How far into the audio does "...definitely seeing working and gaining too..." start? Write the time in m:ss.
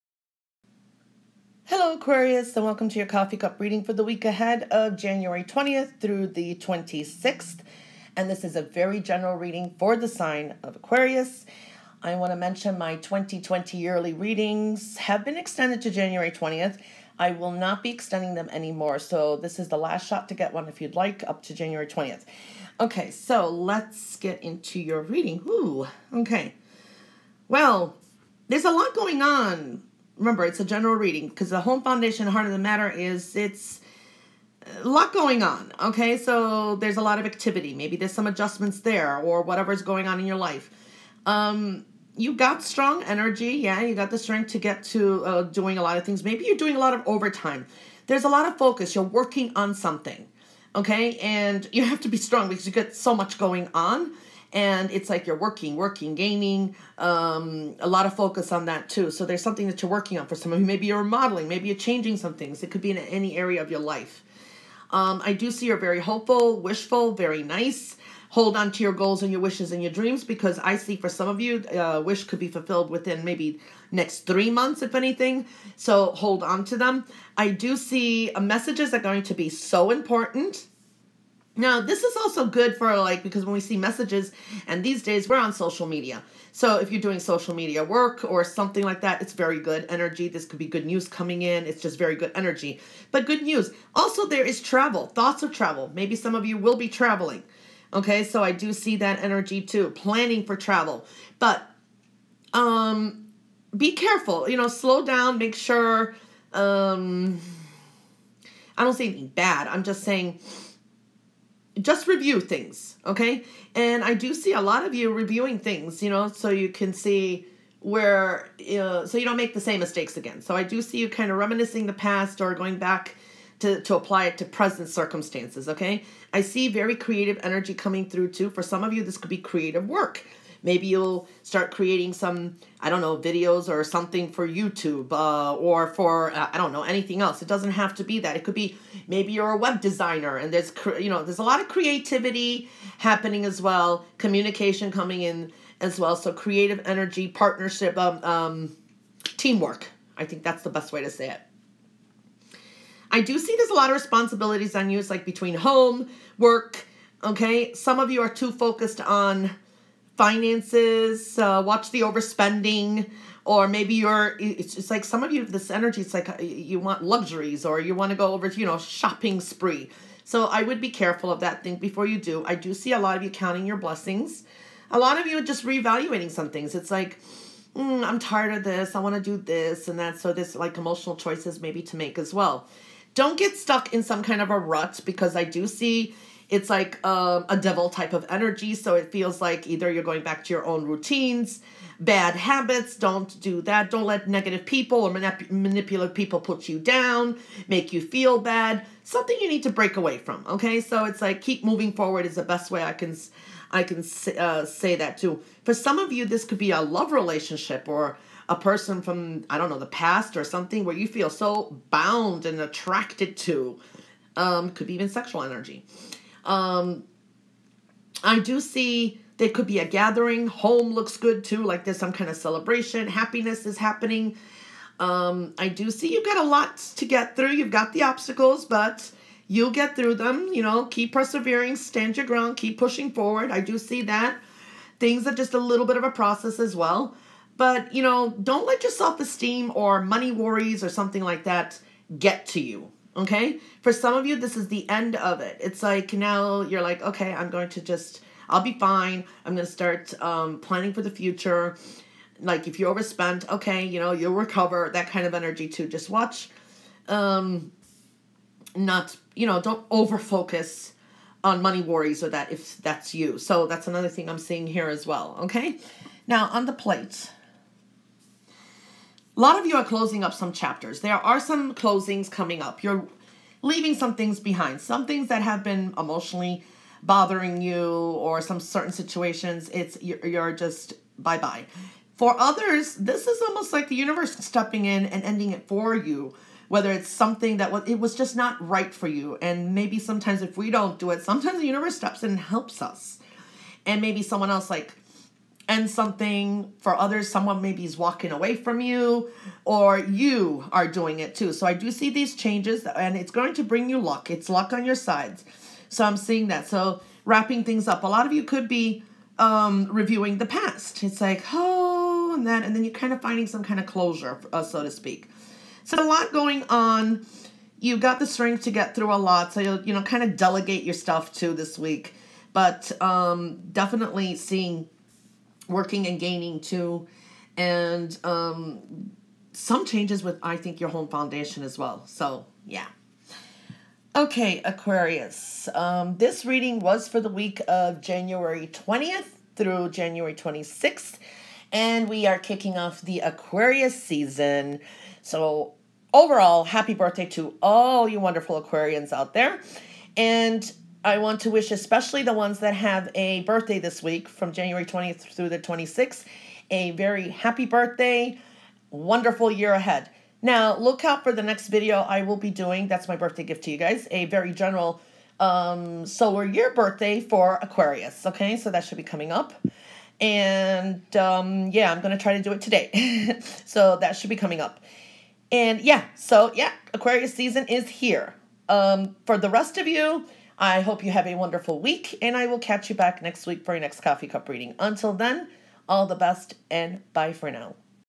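5:23.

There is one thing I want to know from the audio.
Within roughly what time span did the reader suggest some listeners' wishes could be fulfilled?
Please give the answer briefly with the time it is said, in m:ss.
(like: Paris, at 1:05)
next three months, at 1:13.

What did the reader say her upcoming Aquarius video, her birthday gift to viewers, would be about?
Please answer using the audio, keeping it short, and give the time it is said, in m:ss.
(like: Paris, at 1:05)
solar year birthday, at 6:06.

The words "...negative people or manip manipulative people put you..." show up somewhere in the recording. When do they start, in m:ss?
3:14.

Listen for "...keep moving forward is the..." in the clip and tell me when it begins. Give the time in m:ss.
3:21.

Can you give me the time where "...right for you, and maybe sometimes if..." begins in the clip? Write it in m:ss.
4:48.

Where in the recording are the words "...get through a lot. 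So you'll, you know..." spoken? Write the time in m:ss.
5:18.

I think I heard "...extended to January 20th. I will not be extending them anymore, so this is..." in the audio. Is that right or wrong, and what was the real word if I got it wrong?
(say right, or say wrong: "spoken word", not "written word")
right.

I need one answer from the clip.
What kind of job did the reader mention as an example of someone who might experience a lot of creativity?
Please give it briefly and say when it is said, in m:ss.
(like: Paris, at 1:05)
web designer, at 2:19.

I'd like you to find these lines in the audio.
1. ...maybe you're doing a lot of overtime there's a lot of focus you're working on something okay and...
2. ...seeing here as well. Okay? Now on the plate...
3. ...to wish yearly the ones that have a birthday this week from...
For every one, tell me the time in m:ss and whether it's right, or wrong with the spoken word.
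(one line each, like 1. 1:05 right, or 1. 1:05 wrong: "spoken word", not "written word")
1. 0:46 right
2. 4:24 right
3. 5:51 wrong: "especially", not "yearly".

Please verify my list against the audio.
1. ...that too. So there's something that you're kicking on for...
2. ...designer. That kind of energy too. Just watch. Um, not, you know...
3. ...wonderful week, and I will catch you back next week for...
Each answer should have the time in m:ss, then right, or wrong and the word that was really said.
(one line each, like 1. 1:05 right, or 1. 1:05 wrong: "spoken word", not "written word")
1. 0:58 wrong: "working", not "kicking"
2. 4:14 wrong: "recover", not "designer"
3. 6:21 right.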